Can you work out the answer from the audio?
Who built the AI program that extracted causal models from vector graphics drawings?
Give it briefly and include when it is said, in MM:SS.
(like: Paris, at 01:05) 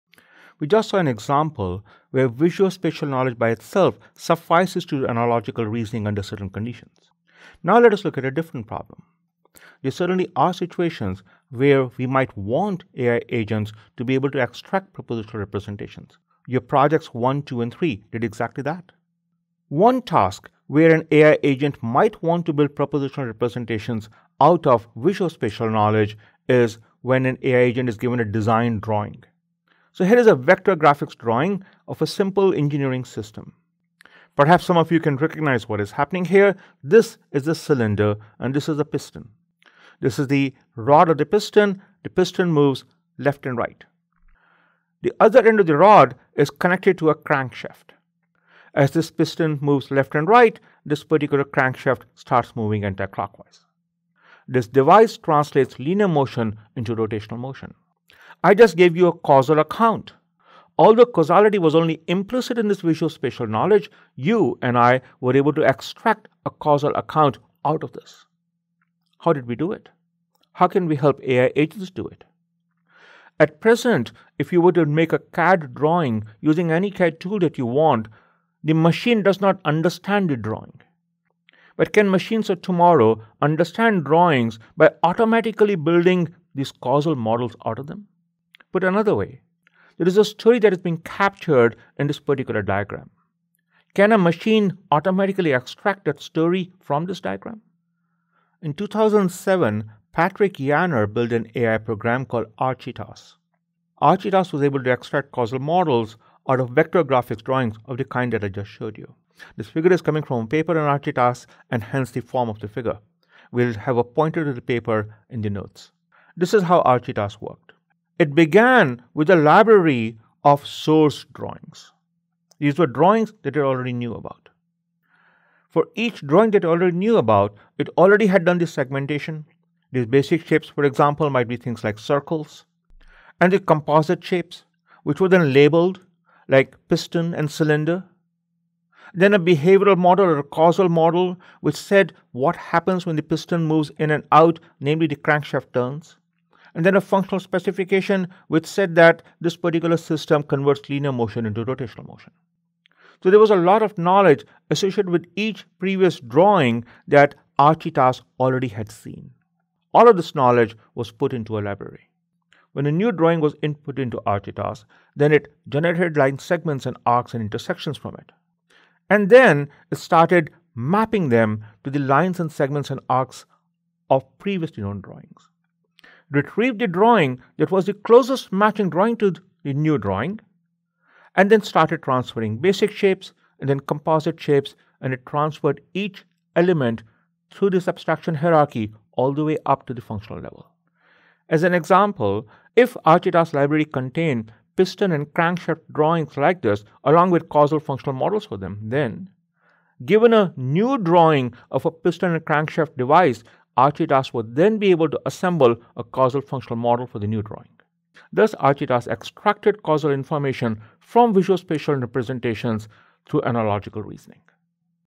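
Patrick Yaner, at 01:40.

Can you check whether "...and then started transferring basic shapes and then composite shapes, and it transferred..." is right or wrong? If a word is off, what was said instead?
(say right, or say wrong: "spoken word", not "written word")
right.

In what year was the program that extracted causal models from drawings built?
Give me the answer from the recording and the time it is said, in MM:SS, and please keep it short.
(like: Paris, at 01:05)
2007, at 01:38.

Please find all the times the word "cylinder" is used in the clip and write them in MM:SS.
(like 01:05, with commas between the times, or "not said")
00:37, 02:17.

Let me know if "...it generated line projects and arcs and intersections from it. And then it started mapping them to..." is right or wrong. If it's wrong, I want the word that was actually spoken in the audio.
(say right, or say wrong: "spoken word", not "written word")
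wrong: "segments", not "projects".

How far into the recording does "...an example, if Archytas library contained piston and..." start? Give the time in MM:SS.
03:11.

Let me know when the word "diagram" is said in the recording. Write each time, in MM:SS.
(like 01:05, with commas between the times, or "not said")
01:32, 01:37.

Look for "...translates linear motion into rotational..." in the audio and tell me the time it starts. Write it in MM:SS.
00:55.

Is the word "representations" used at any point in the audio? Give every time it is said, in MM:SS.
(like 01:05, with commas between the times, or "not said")
00:15, 00:23, 03:32.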